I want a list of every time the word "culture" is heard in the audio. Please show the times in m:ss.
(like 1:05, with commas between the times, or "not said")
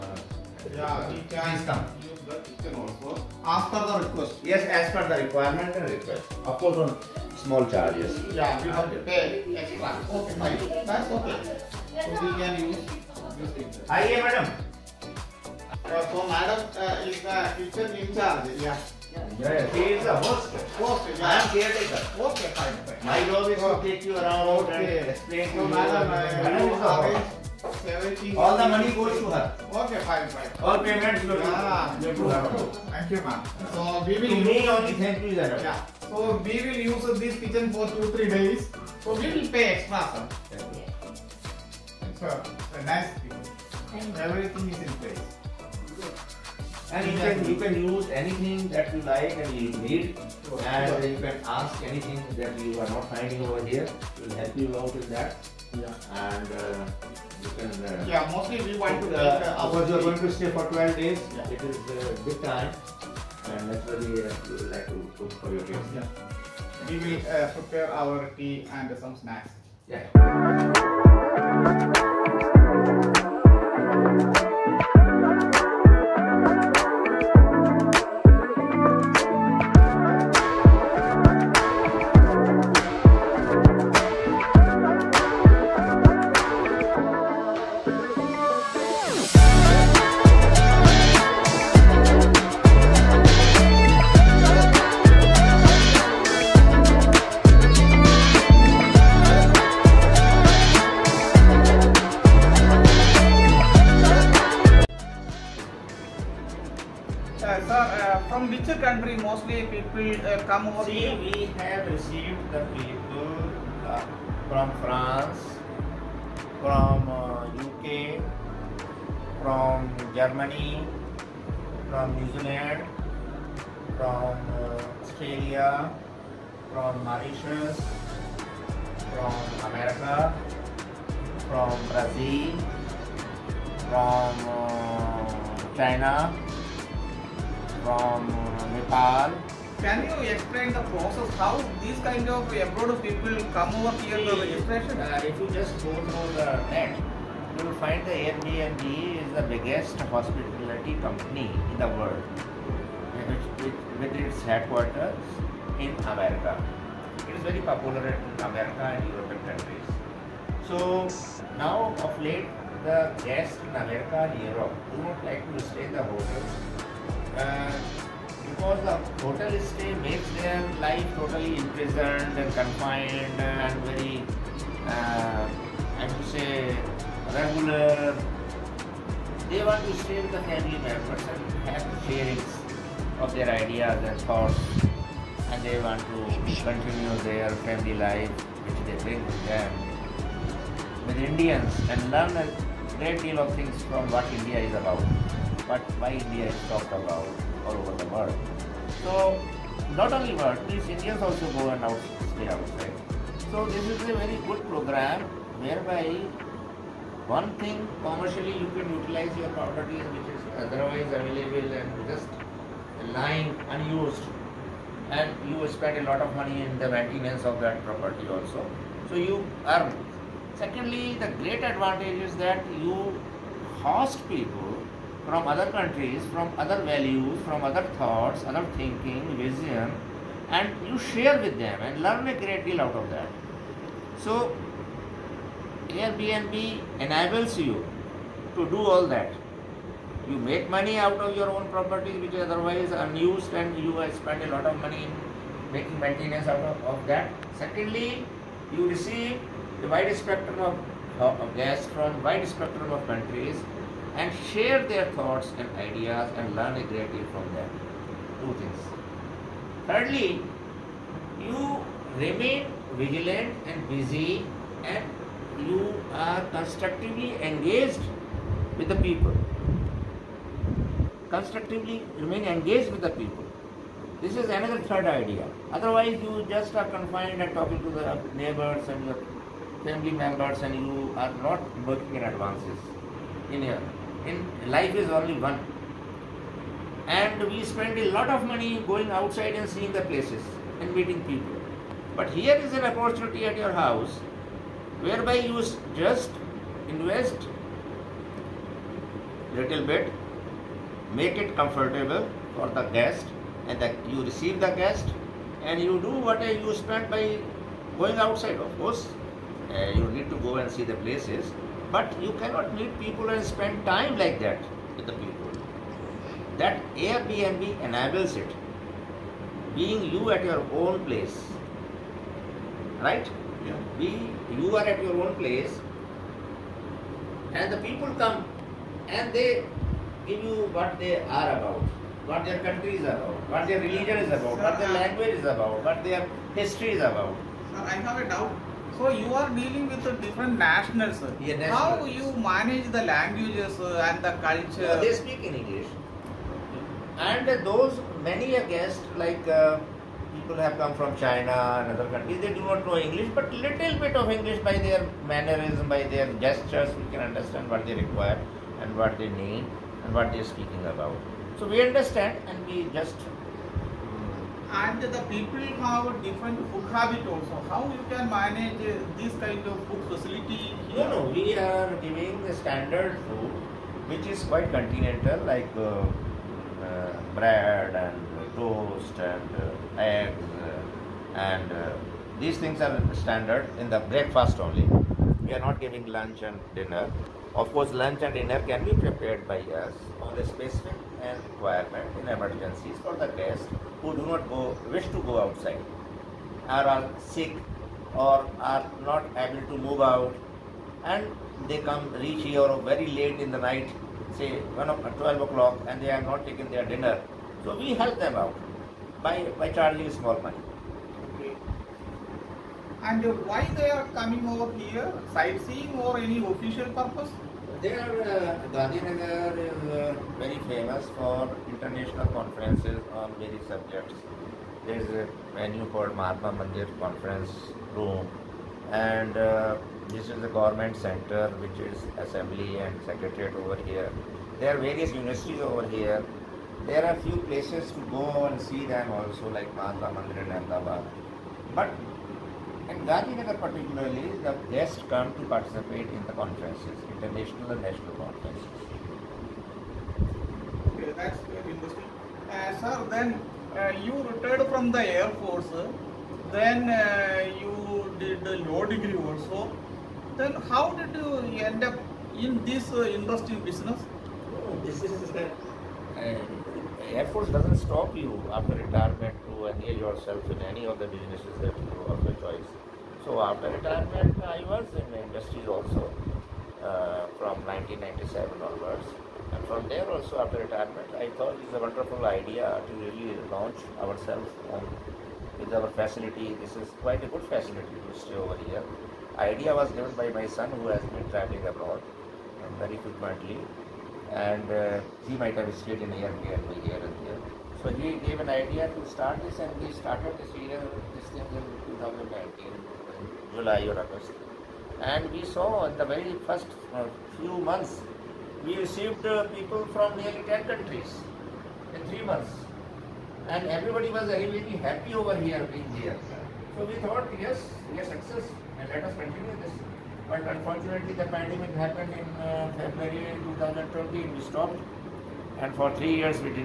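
5:44.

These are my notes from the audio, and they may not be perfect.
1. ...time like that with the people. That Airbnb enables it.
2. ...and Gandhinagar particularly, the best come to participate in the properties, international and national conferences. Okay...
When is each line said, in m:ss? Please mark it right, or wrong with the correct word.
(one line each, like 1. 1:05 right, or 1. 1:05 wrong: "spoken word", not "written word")
1. 5:13 right
2. 7:22 wrong: "conferences", not "properties".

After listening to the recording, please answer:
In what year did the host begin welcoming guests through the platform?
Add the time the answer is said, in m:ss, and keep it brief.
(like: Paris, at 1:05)
2019, at 8:21.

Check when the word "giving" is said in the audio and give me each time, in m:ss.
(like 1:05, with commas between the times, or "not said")
6:12, 6:25.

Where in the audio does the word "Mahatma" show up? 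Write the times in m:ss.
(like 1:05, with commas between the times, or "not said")
7:06, 7:19.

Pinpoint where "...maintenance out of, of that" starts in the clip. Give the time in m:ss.
4:05.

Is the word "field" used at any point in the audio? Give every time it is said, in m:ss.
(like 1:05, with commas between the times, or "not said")
not said.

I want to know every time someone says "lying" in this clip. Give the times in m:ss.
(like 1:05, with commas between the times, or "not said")
3:33.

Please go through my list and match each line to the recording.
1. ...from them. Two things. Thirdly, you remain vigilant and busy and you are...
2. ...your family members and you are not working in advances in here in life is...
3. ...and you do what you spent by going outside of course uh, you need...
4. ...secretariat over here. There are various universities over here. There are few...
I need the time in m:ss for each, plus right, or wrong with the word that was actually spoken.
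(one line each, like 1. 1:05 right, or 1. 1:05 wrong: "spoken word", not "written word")
1. 4:17 right
2. 4:39 right
3. 5:05 right
4. 7:13 right.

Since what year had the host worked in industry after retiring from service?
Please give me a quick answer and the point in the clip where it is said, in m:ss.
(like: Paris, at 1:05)
1997, at 7:57.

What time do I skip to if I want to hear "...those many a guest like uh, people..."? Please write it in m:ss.
5:47.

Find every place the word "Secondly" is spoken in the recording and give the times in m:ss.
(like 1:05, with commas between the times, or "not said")
3:40, 4:07.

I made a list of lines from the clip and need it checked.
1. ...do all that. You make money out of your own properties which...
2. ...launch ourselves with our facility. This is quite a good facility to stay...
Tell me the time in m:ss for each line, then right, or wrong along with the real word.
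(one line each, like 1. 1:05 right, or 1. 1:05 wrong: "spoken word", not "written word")
1. 3:58 right
2. 8:03 right.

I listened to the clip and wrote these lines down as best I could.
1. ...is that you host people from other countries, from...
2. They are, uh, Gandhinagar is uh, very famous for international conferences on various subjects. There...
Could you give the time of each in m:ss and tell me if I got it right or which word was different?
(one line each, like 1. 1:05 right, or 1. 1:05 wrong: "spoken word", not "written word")
1. 3:42 right
2. 6:57 right.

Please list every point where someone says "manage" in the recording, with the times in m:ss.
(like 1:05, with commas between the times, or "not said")
5:42, 6:08.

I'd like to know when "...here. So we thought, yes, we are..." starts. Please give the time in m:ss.
8:35.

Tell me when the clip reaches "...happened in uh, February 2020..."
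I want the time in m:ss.
8:41.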